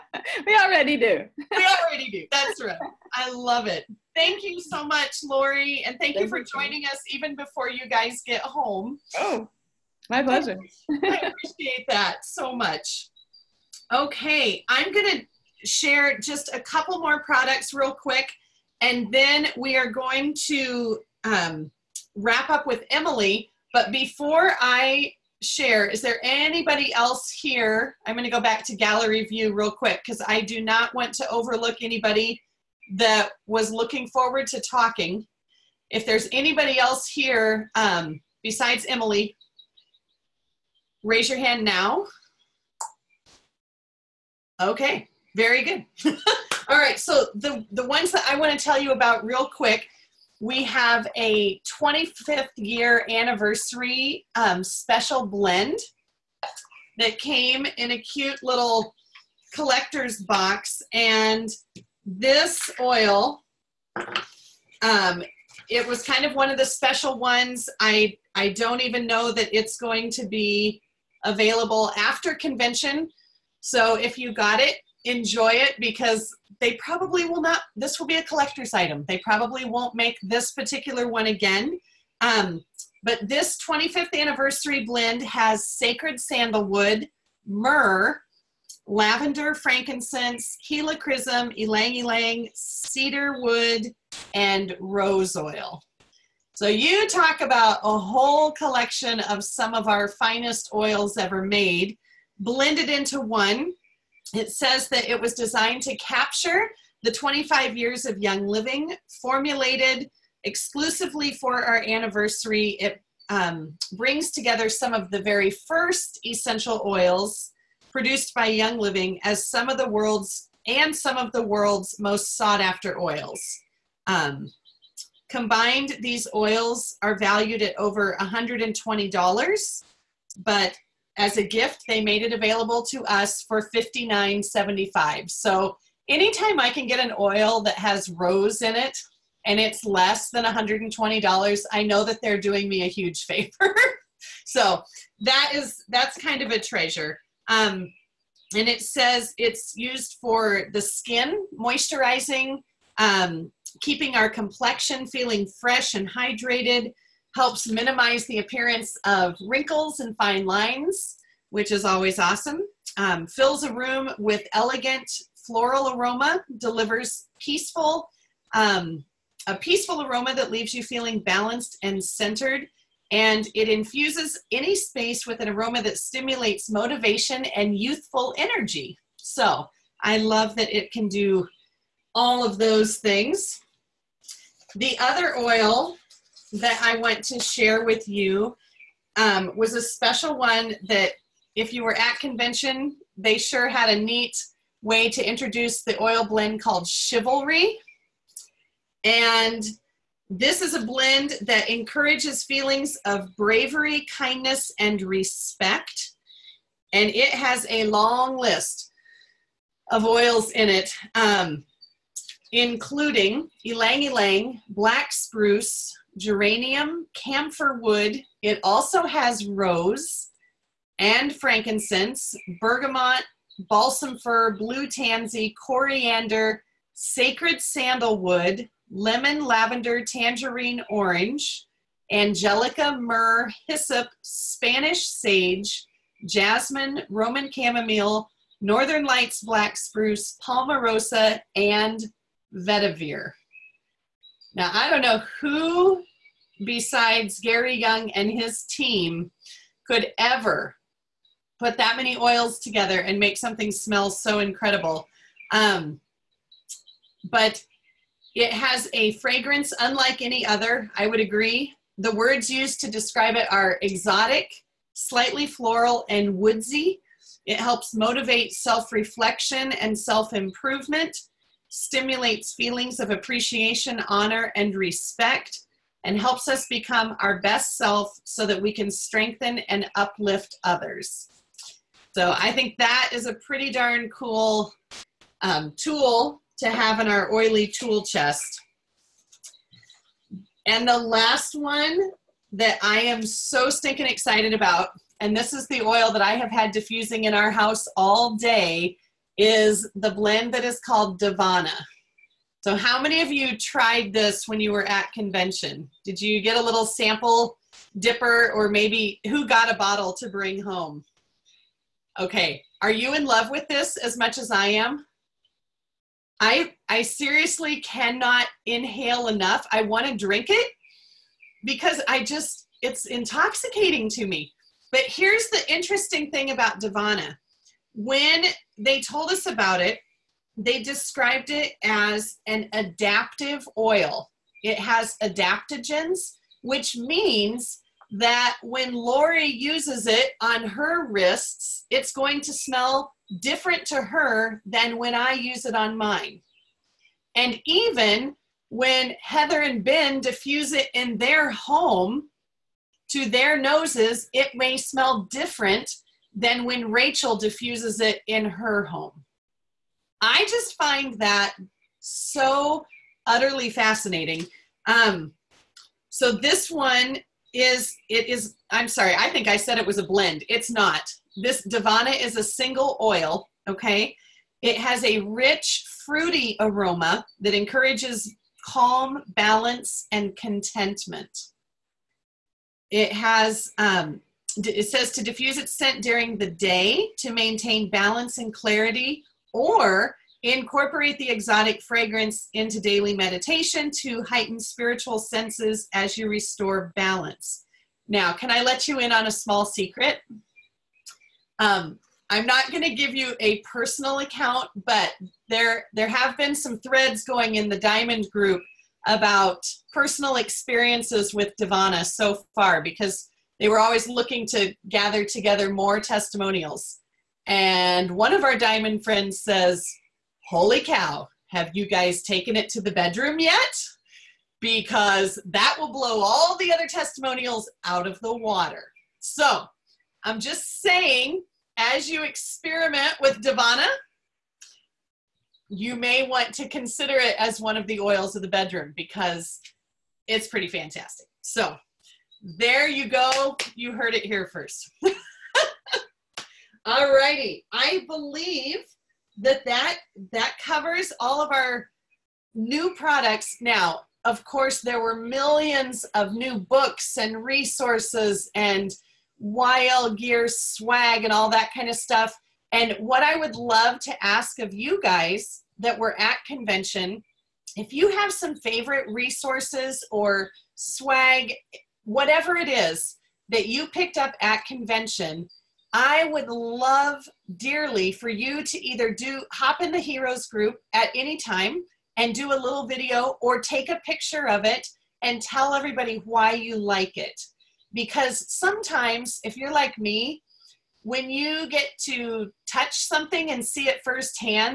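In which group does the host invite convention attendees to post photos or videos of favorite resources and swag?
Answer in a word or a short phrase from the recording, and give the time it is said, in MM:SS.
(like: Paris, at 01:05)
heroes group, at 07:59.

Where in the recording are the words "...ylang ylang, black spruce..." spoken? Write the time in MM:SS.
03:33.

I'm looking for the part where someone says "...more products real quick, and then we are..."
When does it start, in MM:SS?
00:16.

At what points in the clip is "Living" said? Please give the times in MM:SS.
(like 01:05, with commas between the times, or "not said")
01:48, 01:58.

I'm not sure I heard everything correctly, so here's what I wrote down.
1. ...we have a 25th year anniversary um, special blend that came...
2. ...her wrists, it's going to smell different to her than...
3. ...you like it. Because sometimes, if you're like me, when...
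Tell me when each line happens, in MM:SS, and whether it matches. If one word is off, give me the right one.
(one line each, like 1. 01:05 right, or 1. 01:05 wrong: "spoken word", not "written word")
1. 00:50 right
2. 05:40 right
3. 08:06 right.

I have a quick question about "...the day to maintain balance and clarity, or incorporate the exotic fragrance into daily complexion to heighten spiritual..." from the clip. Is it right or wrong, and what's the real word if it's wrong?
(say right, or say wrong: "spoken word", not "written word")
wrong: "meditation", not "complexion".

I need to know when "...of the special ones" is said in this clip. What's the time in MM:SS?
01:06.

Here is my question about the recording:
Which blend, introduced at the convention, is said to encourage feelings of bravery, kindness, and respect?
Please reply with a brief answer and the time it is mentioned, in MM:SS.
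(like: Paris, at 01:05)
Chivalry, at 03:16.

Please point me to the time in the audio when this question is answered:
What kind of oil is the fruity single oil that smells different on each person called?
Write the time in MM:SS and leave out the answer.
05:32.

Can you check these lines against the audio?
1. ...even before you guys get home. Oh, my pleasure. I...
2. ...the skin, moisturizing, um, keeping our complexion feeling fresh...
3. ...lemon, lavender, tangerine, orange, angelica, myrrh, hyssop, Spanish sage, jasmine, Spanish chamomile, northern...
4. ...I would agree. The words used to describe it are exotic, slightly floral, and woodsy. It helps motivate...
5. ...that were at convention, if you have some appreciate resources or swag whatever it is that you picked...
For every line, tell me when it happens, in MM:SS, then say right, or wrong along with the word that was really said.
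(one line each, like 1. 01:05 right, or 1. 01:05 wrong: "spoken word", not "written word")
1. 00:07 right
2. 02:30 right
3. 03:48 wrong: "Roman", not "Spanish"
4. 04:20 right
5. 07:45 wrong: "favorite", not "appreciate".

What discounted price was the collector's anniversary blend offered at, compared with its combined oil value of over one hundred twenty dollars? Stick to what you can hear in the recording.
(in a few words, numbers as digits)
$59.75.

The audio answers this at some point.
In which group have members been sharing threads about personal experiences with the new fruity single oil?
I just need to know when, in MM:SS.
06:47.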